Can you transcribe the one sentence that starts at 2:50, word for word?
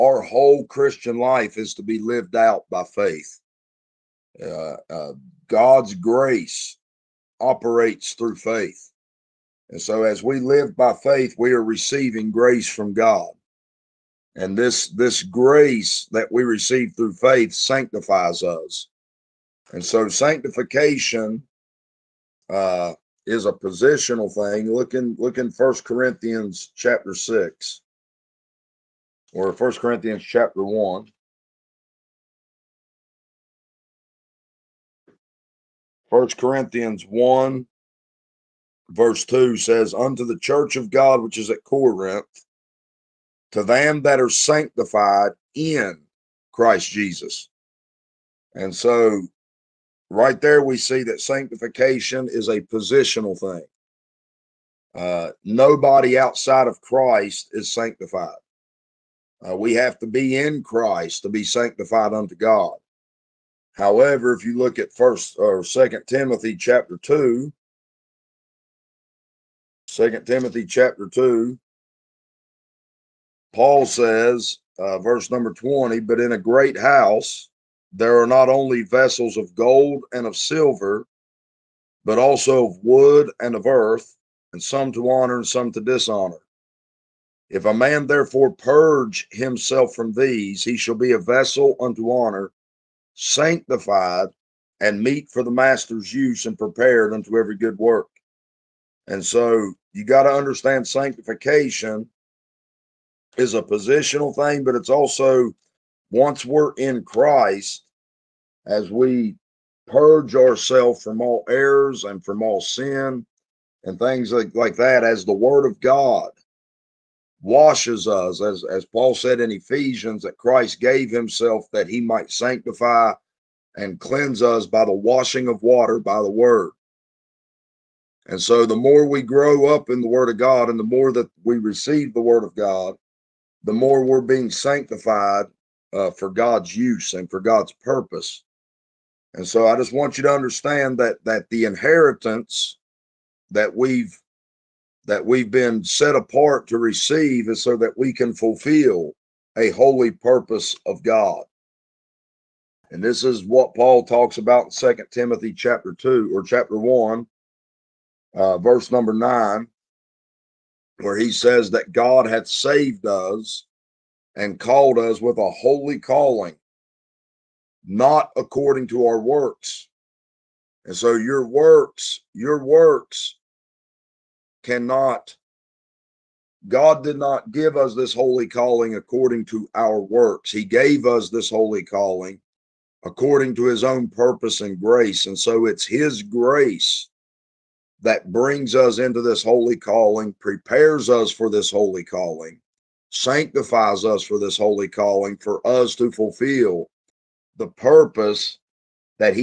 And so your works, your works cannot, God did not give us this holy calling according to our works.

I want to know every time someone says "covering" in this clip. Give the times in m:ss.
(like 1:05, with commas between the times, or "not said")
not said.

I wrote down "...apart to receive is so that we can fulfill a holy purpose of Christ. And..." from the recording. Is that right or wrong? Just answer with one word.
wrong.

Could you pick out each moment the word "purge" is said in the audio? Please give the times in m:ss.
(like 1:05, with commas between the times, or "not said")
1:28, 1:49.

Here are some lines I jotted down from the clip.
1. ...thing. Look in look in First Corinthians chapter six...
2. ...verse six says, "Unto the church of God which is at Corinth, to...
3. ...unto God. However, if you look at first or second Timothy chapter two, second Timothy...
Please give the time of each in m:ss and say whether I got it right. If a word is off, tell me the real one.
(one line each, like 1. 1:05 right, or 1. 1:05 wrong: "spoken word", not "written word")
1. 0:24 right
2. 0:38 wrong: "two", not "six"
3. 1:02 right.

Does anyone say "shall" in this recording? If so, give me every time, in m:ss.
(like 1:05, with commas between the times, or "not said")
1:30.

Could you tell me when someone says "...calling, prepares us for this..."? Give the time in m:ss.
3:09.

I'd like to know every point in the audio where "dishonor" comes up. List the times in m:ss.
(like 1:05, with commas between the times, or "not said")
1:25.